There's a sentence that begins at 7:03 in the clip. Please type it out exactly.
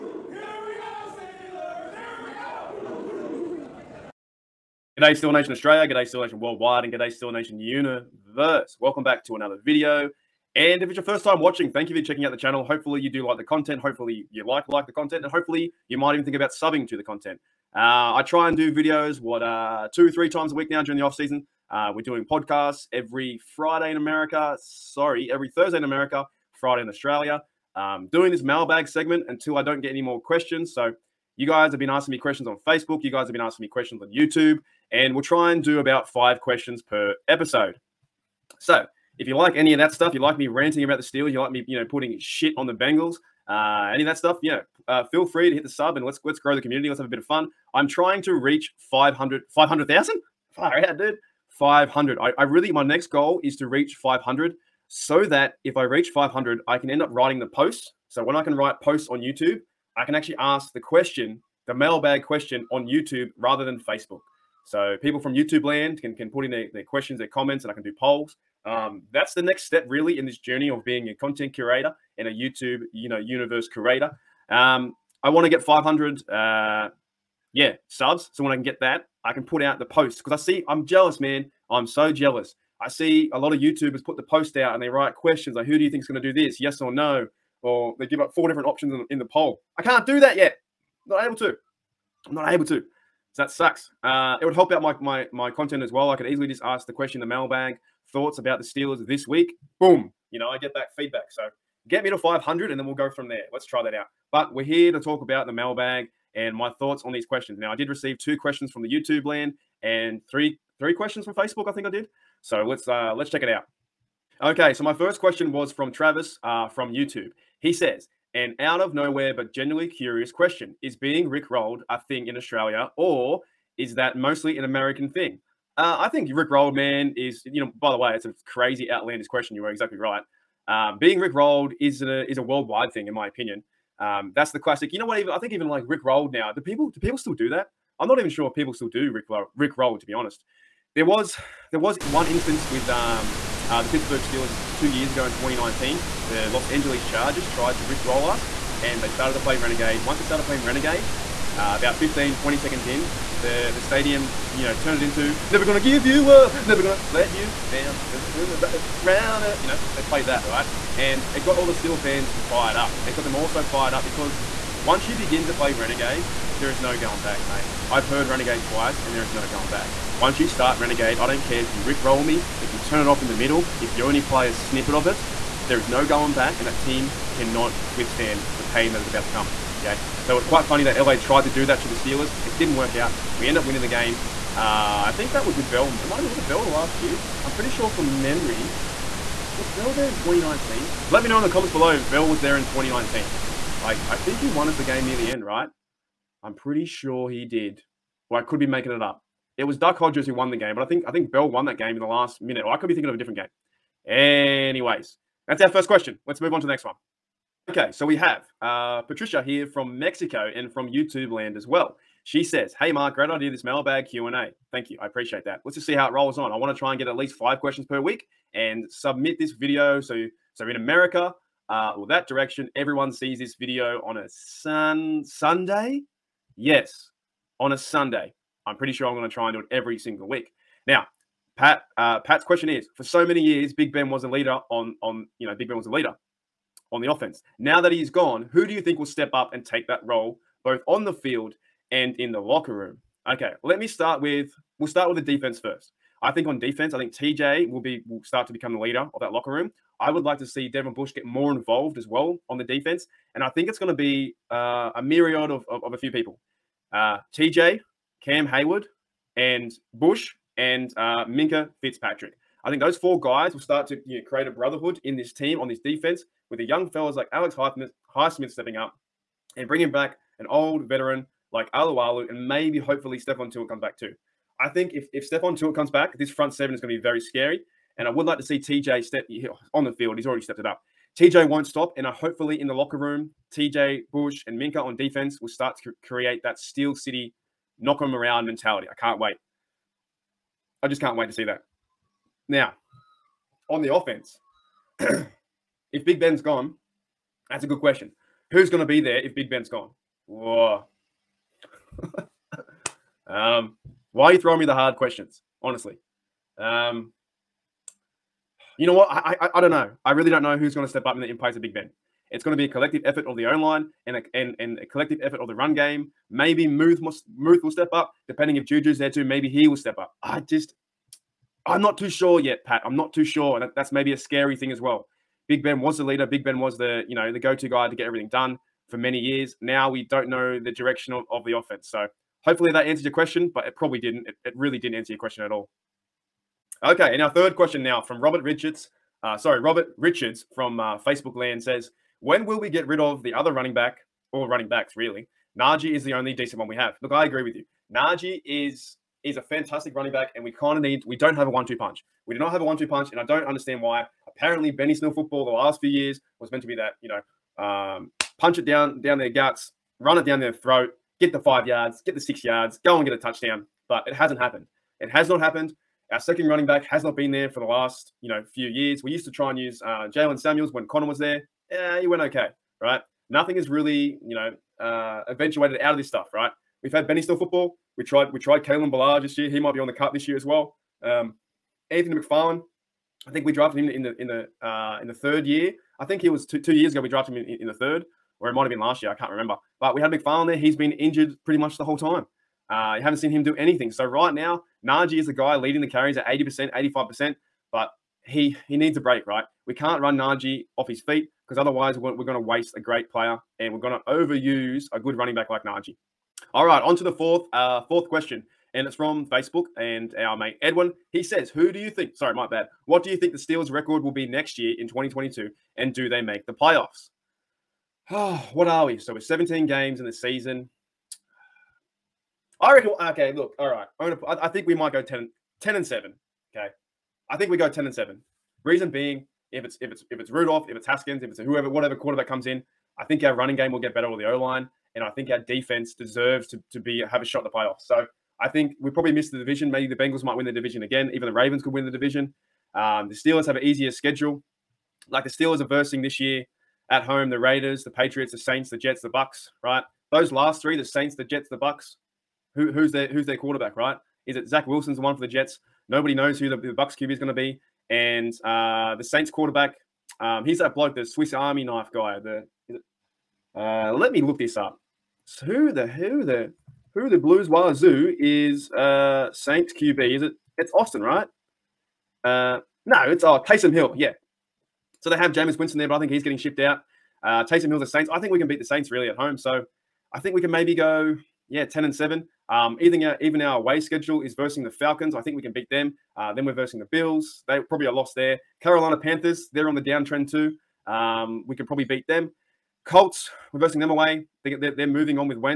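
I'm gonna, I, I think we might go 10, 10 and 7.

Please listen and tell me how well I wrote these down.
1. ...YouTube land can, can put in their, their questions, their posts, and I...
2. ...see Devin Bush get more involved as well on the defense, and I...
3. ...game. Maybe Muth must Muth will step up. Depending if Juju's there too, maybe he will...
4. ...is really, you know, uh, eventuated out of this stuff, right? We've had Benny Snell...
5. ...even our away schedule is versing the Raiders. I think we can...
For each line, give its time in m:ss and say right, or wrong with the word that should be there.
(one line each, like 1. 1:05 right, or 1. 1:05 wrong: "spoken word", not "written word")
1. 1:05 wrong: "comments", not "posts"
2. 4:10 right
3. 5:15 right
4. 6:13 right
5. 8:03 wrong: "Falcons", not "Raiders".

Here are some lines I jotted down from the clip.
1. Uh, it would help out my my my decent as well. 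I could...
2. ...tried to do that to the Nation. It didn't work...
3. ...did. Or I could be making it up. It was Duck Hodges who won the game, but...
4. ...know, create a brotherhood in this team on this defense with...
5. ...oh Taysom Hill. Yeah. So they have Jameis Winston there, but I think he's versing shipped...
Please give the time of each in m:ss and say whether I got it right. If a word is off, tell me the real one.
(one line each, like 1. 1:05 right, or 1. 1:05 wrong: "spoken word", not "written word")
1. 1:34 wrong: "content", not "decent"
2. 3:01 wrong: "Steelers", not "Nation"
3. 3:17 right
4. 4:24 right
5. 7:53 wrong: "getting", not "versing".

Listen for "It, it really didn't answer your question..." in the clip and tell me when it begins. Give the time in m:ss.
5:34.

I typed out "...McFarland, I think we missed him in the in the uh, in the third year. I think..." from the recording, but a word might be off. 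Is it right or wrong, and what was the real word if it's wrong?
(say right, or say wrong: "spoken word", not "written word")
wrong: "drafted", not "missed".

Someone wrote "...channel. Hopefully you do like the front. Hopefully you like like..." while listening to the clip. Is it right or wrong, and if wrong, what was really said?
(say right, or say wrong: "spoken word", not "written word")
wrong: "content", not "front".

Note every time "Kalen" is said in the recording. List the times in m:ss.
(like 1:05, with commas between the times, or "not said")
6:18.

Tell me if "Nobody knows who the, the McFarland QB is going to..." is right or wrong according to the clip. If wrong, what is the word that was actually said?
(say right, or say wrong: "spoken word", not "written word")
wrong: "Bucks", not "McFarland".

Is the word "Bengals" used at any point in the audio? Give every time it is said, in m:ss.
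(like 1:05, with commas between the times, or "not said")
0:42, 7:19.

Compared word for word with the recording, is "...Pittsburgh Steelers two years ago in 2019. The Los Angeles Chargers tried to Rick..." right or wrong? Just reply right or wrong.
right.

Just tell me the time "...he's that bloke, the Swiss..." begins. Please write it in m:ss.
7:40.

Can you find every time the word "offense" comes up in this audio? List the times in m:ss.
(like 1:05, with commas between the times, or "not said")
3:57, 4:53, 5:31.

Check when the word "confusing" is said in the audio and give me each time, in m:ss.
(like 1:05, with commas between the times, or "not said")
not said.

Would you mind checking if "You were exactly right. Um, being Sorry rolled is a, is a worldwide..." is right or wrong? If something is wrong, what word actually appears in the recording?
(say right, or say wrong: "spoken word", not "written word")
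wrong: "Rick", not "Sorry".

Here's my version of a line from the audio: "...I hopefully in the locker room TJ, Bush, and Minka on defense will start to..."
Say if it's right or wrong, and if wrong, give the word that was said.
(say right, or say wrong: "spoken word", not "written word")
right.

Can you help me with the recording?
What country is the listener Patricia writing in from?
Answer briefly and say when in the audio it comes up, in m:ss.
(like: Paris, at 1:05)
Mexico, at 3:29.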